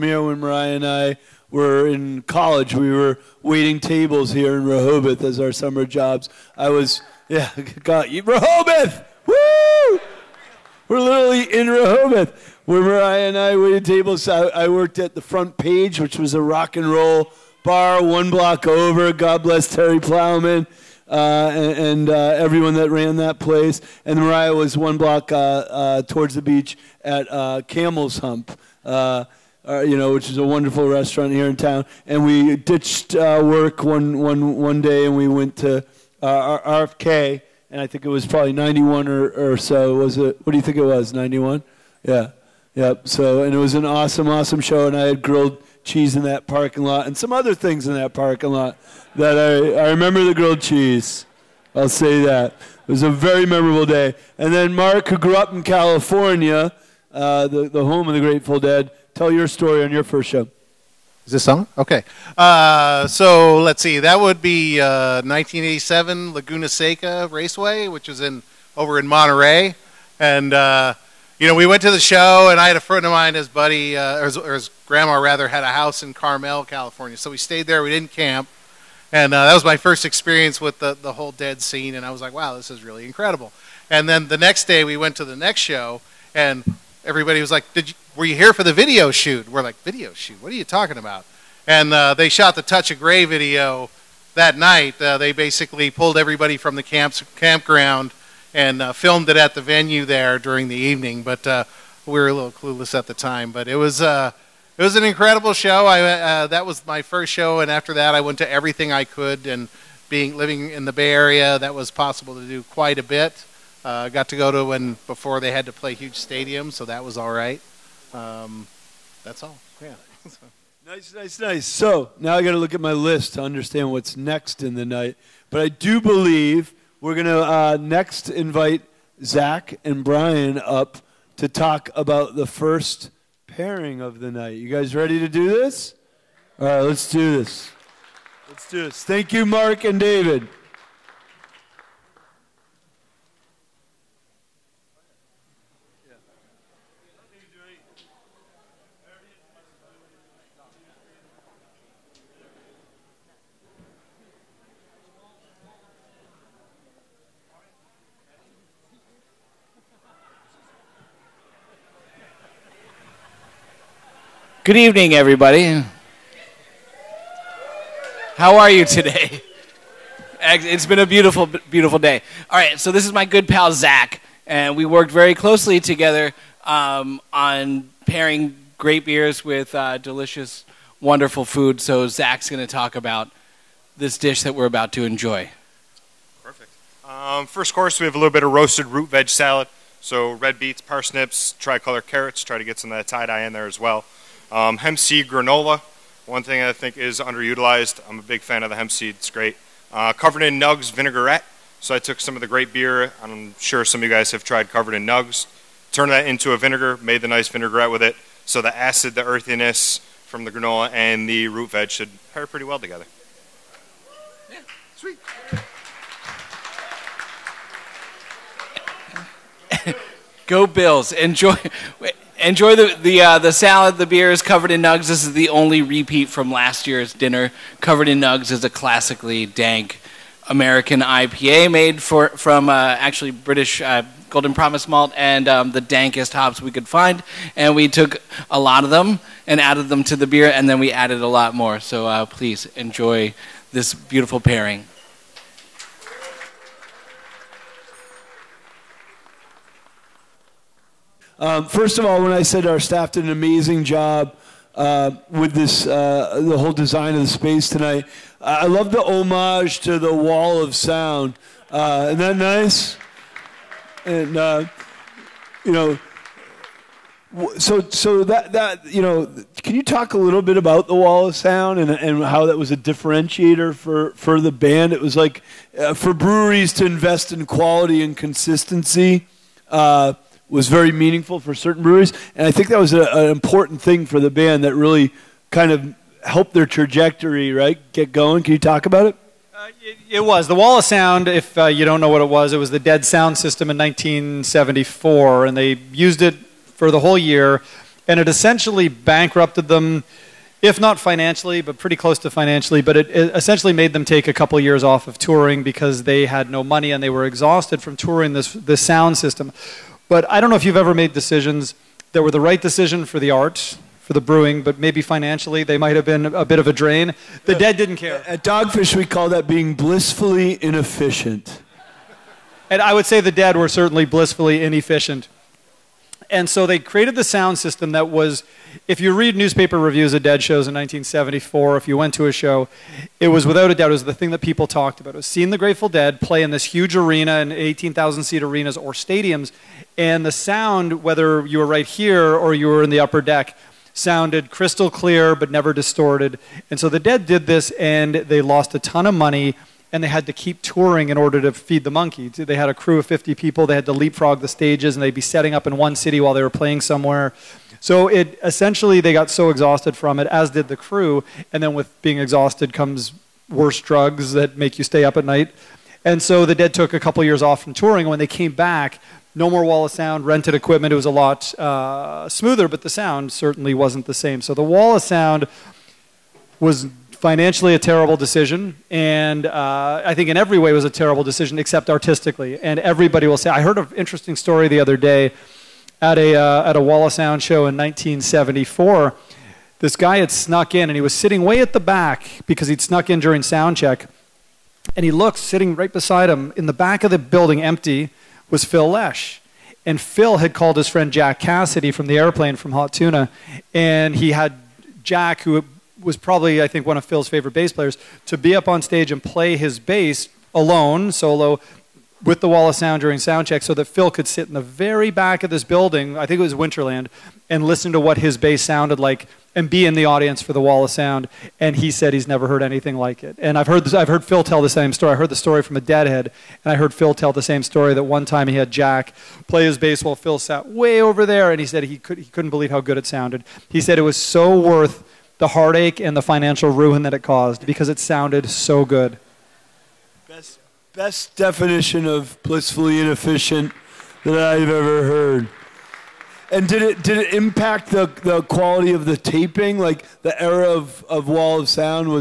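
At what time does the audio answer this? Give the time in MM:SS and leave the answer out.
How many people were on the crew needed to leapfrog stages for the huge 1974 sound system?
05:53.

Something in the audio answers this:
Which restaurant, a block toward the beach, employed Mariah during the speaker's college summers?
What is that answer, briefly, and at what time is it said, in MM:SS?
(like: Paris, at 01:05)
Camel's Hump, at 00:27.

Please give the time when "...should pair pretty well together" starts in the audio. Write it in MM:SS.
03:31.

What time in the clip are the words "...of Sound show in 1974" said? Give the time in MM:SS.
06:27.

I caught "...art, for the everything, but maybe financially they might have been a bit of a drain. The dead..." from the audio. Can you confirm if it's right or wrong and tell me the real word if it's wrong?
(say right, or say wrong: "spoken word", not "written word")
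wrong: "brewing", not "everything".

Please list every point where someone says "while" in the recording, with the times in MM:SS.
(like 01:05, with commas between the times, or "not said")
05:56, 07:10.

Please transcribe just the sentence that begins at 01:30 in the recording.
What are you talking about?" And uh, they shot the Touch of Grey video that night.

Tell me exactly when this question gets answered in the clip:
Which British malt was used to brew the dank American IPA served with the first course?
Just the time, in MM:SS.
03:54.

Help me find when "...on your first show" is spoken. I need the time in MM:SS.
00:59.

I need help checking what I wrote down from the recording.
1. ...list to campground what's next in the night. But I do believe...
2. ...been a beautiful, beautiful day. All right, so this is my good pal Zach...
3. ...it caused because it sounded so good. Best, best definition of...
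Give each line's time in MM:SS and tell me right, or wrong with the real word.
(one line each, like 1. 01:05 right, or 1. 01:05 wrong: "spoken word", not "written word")
1. 02:02 wrong: "understand", not "campground"
2. 02:50 right
3. 07:17 right.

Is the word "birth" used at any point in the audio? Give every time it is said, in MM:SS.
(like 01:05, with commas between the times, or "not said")
not said.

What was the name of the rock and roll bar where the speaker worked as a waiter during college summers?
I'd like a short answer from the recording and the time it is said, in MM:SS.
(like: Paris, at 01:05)
The Front Page, at 00:15.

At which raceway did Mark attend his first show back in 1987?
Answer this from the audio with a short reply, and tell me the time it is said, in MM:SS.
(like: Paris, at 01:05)
Laguna Seca Raceway, at 01:06.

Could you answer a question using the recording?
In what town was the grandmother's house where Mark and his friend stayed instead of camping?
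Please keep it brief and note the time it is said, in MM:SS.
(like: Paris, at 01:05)
Carmel, at 01:16.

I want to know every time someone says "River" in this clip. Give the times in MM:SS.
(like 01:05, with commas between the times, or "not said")
not said.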